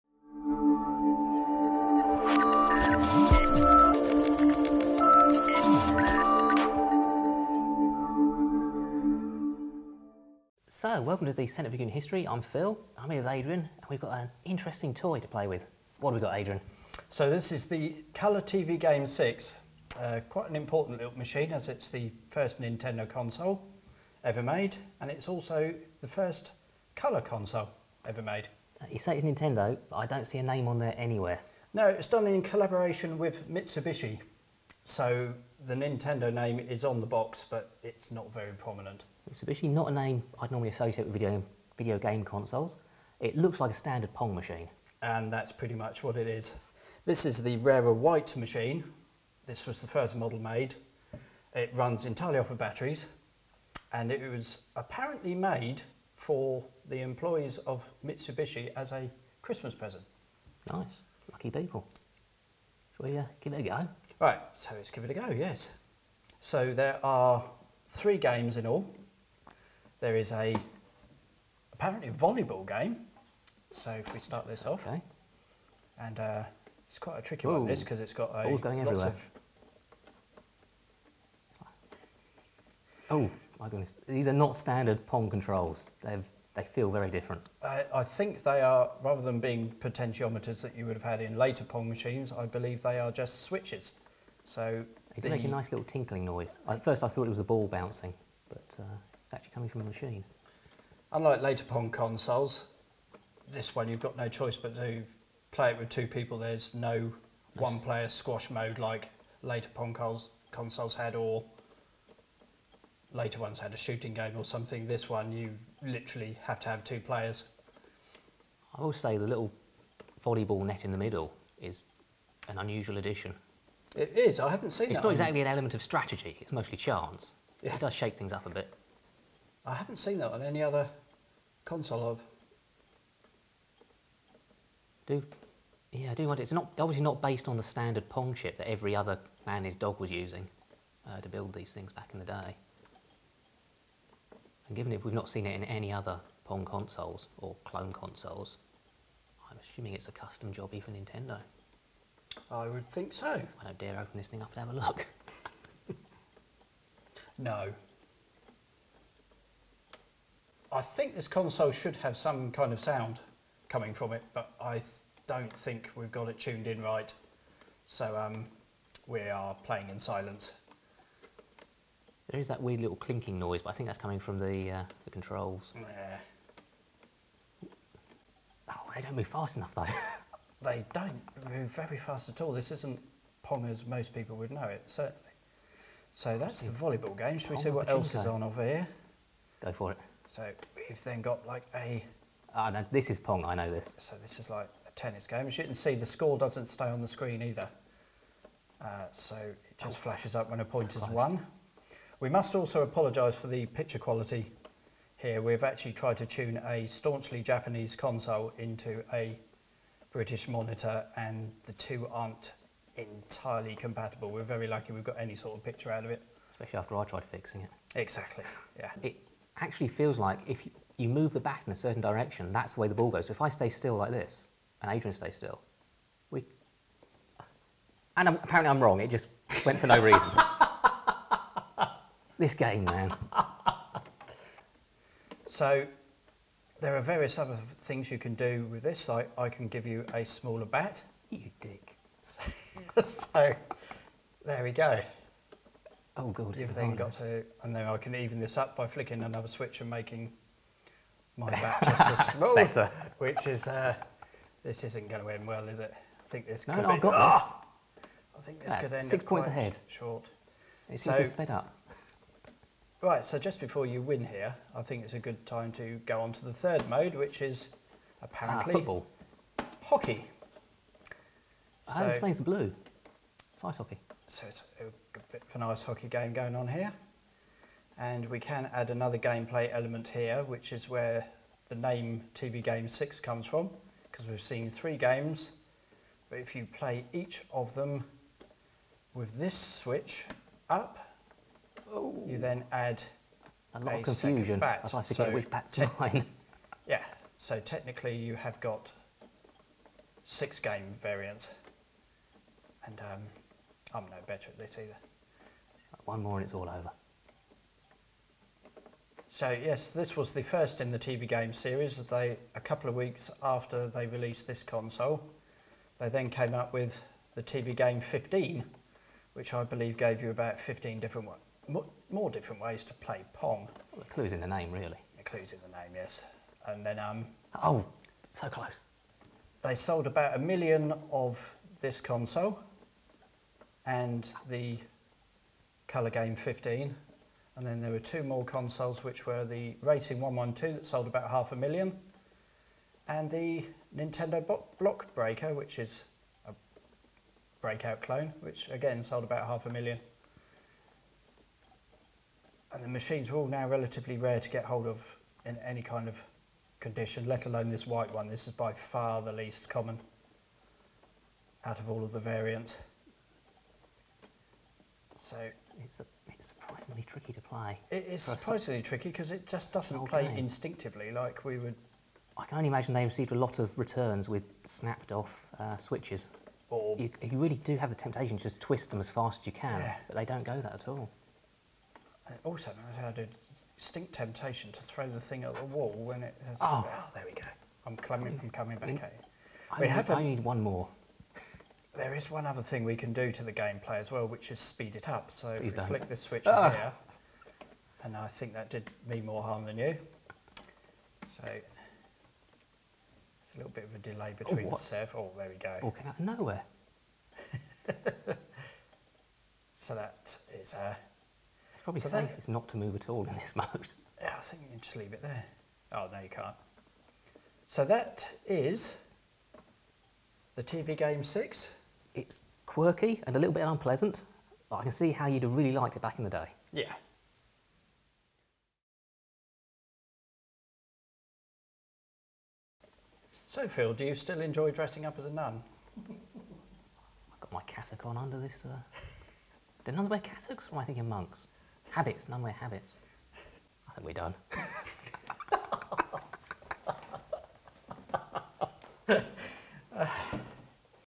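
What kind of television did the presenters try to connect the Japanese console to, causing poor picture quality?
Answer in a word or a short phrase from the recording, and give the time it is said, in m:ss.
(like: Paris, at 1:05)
British monitor, at 3:30.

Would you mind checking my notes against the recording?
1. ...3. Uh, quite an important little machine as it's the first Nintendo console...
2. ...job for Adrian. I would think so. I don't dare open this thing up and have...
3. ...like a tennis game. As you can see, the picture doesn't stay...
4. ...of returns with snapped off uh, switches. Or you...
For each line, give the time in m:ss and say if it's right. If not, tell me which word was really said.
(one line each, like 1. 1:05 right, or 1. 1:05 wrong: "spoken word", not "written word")
1. 0:19 wrong: "6", not "3"
2. 2:30 wrong: "Nintendo", not "Adrian"
3. 3:14 wrong: "score", not "picture"
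4. 6:13 right.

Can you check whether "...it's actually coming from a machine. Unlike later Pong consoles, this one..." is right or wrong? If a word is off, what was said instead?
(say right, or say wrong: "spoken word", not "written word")
right.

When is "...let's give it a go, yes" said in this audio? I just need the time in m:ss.
1:04.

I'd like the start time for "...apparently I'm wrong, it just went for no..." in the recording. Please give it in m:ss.
3:48.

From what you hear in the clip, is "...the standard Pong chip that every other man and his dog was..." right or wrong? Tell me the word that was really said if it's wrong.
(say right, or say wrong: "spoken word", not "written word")
right.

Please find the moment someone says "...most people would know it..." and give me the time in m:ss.
3:03.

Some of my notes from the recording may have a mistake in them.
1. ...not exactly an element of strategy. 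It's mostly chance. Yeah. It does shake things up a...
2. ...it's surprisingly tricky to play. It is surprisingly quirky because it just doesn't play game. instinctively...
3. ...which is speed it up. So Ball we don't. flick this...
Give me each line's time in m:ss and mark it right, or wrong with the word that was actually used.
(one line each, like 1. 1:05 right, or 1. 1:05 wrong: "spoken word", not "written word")
1. 2:05 right
2. 6:06 wrong: "tricky", not "quirky"
3. 6:34 wrong: "Please", not "Ball".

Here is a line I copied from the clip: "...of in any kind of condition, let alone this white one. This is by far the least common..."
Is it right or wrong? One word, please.
right.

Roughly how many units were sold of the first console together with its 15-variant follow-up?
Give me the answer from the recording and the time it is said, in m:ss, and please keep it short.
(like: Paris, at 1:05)
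about a million, at 5:30.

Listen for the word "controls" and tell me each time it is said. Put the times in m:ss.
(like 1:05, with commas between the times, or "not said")
1:25, 2:55.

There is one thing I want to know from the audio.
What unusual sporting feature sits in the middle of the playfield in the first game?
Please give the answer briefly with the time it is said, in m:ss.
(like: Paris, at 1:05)
volleyball net, at 2:00.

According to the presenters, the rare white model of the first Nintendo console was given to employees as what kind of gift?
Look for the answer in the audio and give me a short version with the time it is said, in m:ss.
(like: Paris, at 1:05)
Christmas present, at 0:59.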